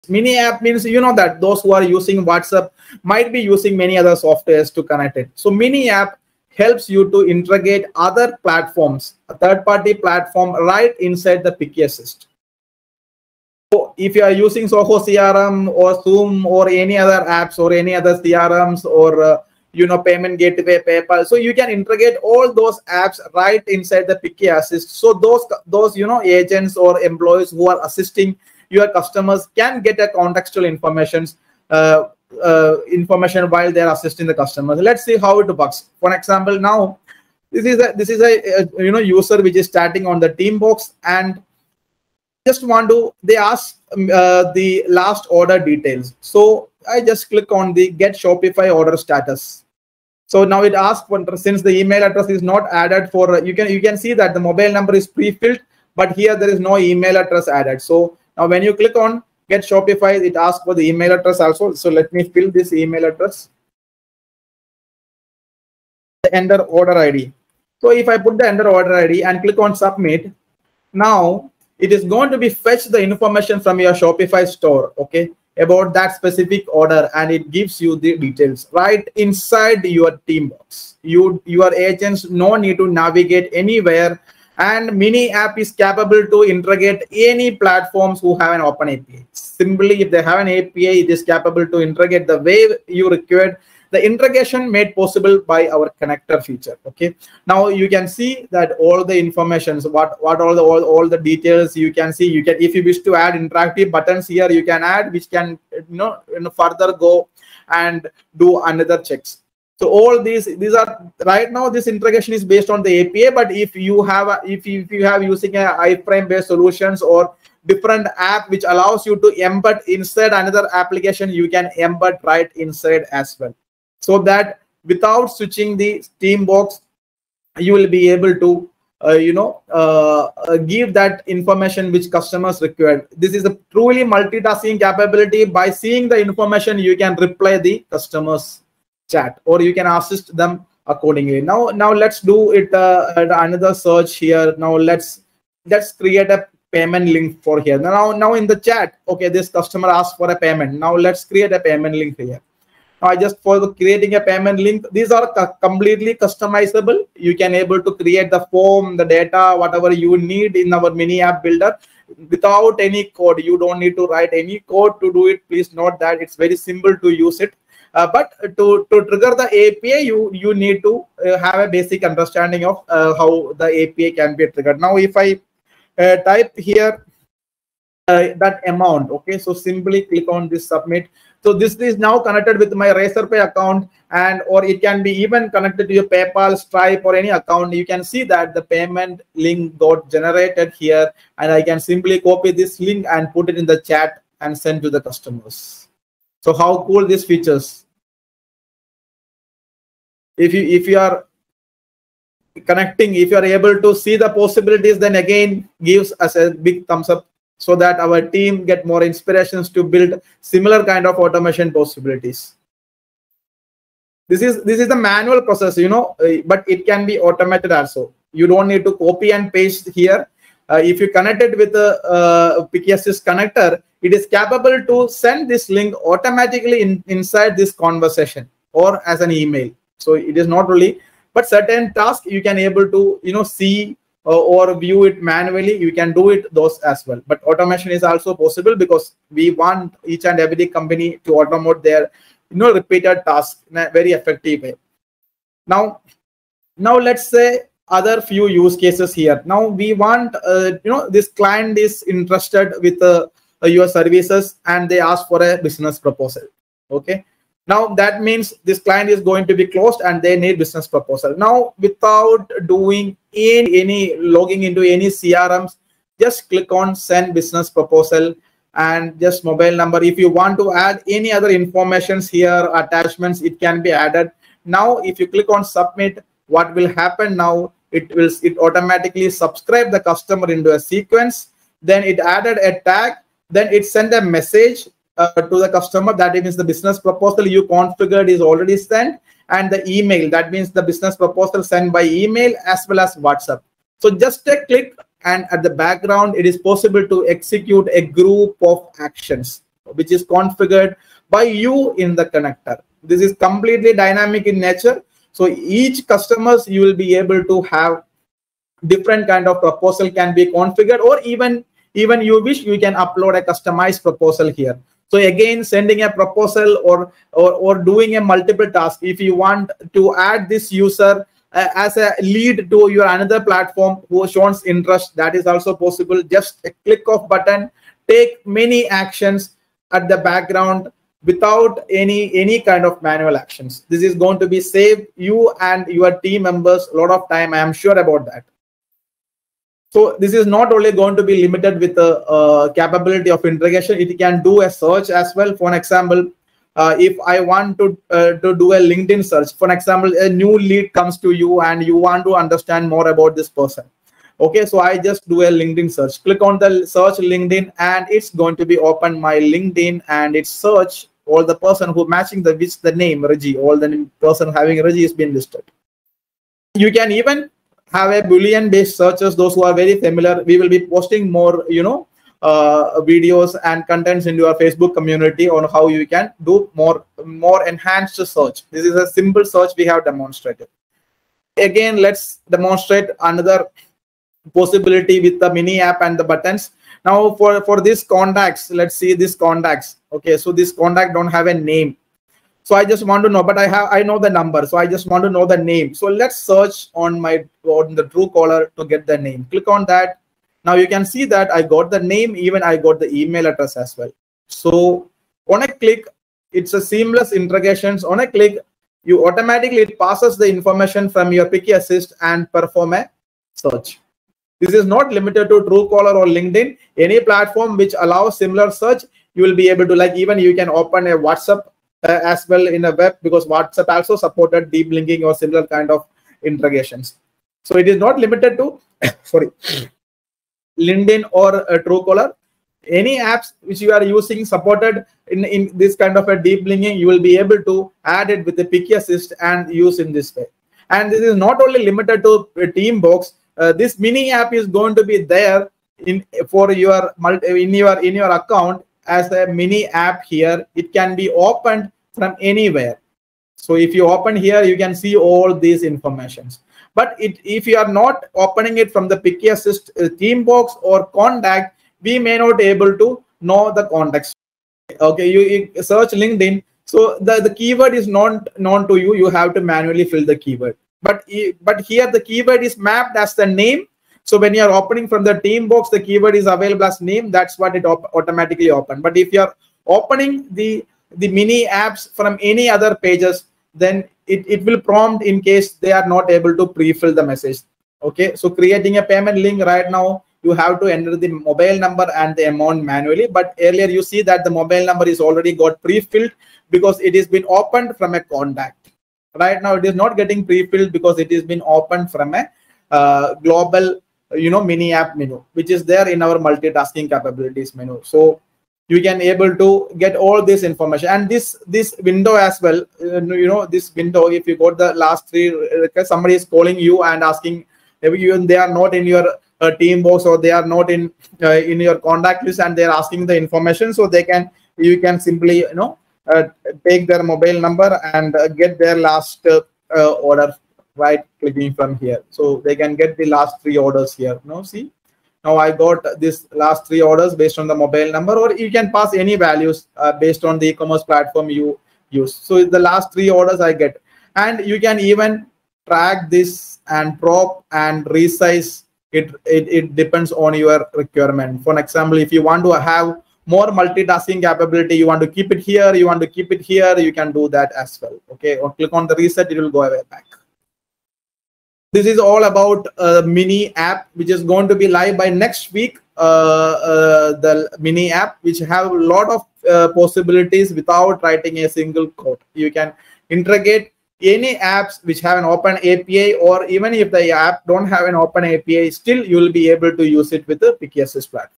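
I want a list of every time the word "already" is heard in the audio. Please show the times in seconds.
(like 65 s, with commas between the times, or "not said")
288 s, 495 s.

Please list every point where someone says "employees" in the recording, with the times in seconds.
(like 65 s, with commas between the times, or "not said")
27 s.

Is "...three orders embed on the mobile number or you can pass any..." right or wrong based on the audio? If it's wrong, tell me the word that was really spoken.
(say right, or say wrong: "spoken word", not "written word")
wrong: "based", not "embed".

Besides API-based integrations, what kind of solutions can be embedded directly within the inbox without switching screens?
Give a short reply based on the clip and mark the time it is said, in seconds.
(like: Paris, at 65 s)
iframe based solutions, at 115 s.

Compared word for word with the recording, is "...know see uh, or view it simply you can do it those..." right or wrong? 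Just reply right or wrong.
wrong.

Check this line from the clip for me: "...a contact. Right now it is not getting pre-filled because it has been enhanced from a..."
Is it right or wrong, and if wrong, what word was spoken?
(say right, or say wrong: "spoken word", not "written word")
wrong: "opened", not "enhanced".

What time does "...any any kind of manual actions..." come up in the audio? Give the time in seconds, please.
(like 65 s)
331 s.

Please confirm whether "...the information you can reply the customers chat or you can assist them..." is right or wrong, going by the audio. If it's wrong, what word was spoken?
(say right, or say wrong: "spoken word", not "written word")
right.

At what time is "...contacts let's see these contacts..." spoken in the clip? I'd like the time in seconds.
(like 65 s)
388 s.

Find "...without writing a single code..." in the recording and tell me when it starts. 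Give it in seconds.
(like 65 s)
570 s.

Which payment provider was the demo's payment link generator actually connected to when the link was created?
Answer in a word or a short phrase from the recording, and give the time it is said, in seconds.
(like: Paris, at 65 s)
Razorpay, at 182 s.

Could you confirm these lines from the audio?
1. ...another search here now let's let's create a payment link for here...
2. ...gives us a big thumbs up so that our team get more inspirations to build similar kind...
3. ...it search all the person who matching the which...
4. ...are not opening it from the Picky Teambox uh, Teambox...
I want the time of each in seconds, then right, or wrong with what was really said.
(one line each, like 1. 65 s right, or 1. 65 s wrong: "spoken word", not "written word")
1. 143 s right
2. 205 s right
3. 360 s right
4. 457 s wrong: "Assist", not "Teambox".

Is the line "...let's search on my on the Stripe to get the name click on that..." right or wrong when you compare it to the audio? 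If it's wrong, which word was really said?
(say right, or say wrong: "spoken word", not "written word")
wrong: "Truecaller", not "Stripe".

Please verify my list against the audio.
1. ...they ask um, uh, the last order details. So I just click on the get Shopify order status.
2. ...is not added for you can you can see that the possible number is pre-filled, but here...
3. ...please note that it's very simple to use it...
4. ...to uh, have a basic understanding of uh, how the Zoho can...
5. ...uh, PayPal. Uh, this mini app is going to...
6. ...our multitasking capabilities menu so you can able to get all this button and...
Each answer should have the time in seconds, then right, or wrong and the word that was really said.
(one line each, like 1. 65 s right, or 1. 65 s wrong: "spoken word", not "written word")
1. 43 s right
2. 52 s wrong: "mobile", not "possible"
3. 165 s right
4. 170 s wrong: "API", not "Zoho"
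5. 442 s wrong: "Teambox", not "PayPal"
6. 506 s wrong: "information", not "button".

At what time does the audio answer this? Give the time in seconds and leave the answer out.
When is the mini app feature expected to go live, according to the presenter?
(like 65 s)
565 s.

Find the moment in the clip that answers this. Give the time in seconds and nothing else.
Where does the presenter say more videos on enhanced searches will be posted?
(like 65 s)
374 s.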